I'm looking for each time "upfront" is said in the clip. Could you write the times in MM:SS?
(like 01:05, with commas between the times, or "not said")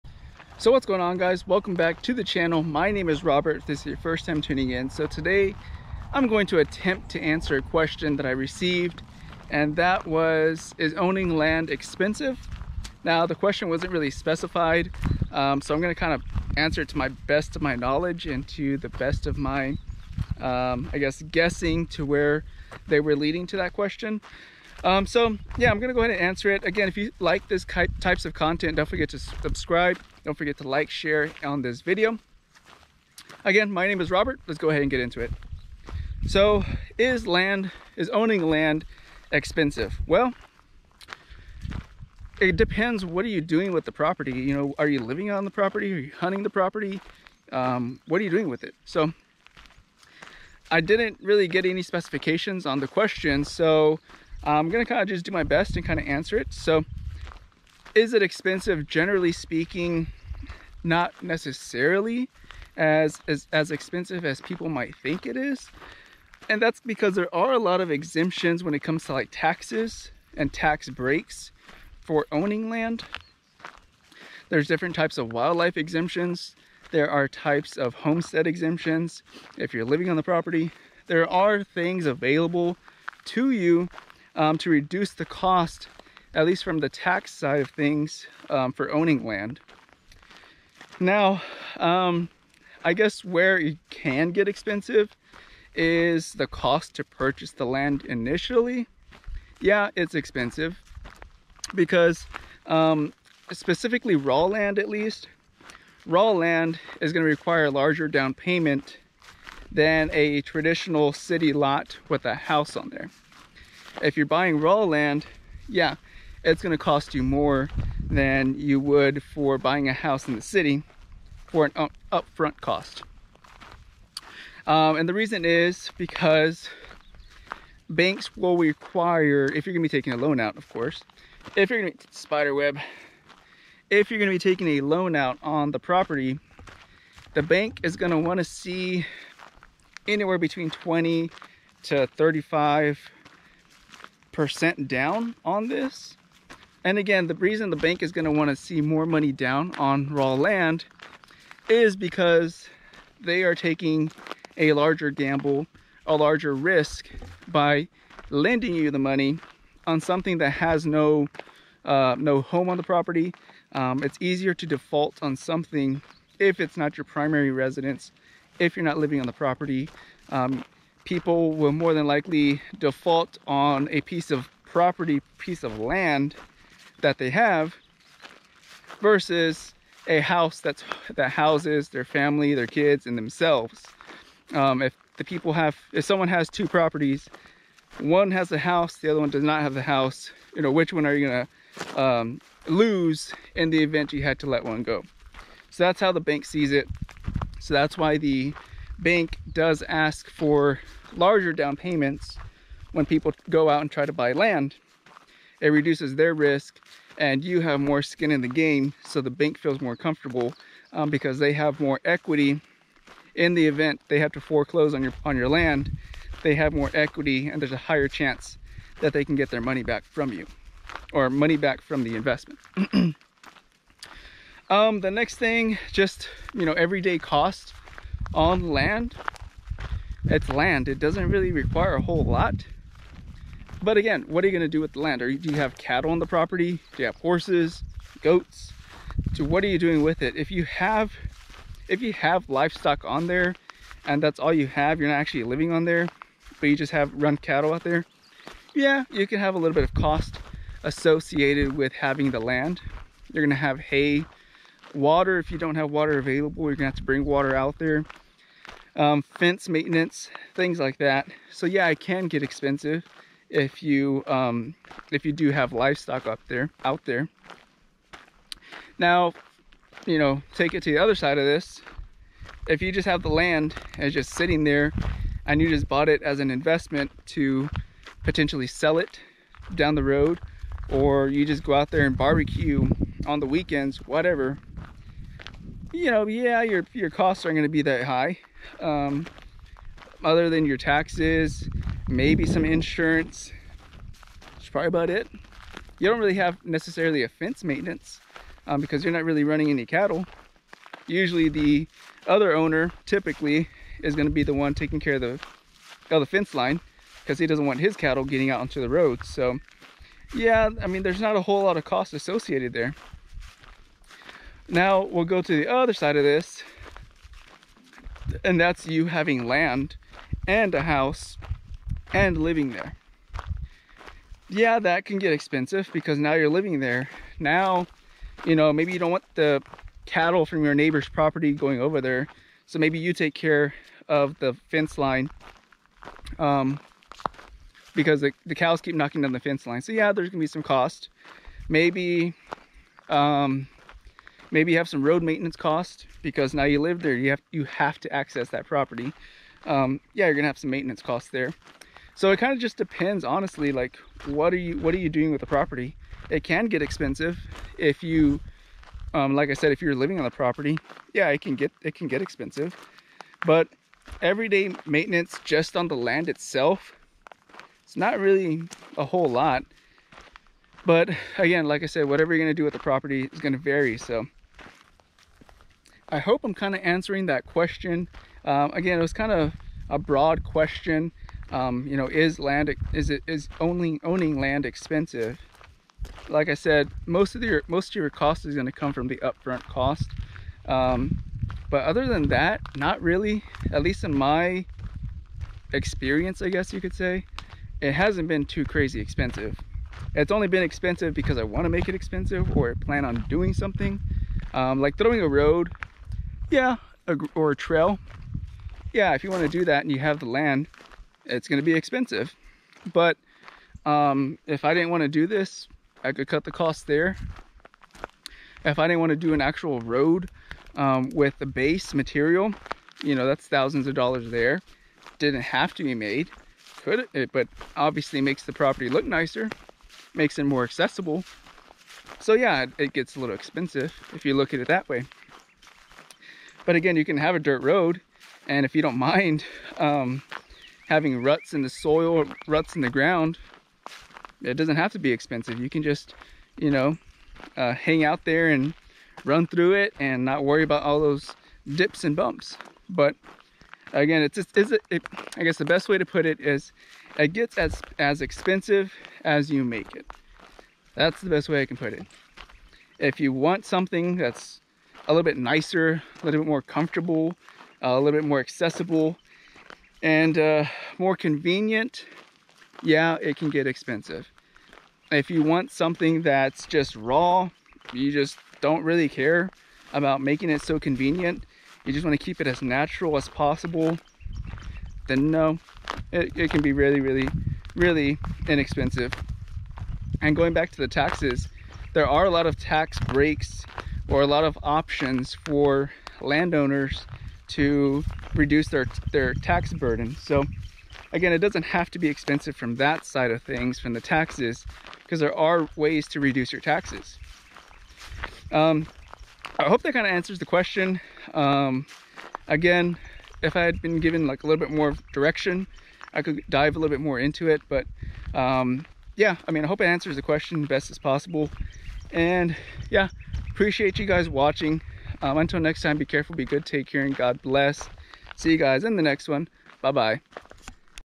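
02:02, 06:29.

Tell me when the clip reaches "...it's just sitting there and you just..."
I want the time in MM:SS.
04:34.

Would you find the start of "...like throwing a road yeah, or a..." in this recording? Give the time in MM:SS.
06:44.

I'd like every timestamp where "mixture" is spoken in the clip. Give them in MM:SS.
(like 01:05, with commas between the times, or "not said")
not said.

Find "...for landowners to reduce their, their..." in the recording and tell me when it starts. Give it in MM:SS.
08:15.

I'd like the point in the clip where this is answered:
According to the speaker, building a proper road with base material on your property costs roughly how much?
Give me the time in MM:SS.
07:03.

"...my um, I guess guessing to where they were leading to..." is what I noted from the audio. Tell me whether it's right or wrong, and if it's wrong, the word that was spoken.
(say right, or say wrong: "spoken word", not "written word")
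right.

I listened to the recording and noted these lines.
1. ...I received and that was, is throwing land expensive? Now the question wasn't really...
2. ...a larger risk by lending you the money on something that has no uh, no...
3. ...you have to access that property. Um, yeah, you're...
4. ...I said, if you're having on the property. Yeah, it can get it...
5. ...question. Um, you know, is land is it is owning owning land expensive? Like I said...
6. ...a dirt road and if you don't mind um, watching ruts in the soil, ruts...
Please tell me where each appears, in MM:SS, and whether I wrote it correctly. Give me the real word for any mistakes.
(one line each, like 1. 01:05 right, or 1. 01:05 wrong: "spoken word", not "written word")
1. 00:08 wrong: "owning", not "throwing"
2. 02:36 right
3. 05:47 right
4. 05:59 wrong: "living", not "having"
5. 06:20 right
6. 07:17 wrong: "having", not "watching".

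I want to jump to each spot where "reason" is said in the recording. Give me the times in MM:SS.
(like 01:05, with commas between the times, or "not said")
02:05, 02:27.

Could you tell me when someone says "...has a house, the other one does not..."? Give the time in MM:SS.
03:08.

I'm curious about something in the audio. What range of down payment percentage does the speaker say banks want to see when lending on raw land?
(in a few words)
20 to 35 percent.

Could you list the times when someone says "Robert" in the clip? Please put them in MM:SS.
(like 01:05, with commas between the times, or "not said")
00:03, 00:34.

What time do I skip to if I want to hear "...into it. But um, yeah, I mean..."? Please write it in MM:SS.
08:37.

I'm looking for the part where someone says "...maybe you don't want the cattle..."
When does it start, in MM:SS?
05:28.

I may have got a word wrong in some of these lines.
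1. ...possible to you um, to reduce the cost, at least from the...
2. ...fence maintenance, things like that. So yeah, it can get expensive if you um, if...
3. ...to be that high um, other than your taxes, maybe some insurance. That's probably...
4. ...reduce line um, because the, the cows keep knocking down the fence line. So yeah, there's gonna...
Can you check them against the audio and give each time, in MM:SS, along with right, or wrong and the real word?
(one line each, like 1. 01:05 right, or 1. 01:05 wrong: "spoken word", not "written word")
1. 01:22 wrong: "available", not "possible"
2. 04:19 right
3. 04:47 right
4. 05:34 wrong: "fence", not "reduce".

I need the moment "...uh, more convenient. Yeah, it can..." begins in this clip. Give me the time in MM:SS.
07:50.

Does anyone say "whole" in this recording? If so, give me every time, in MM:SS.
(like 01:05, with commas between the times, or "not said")
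03:52, 05:11, 06:09.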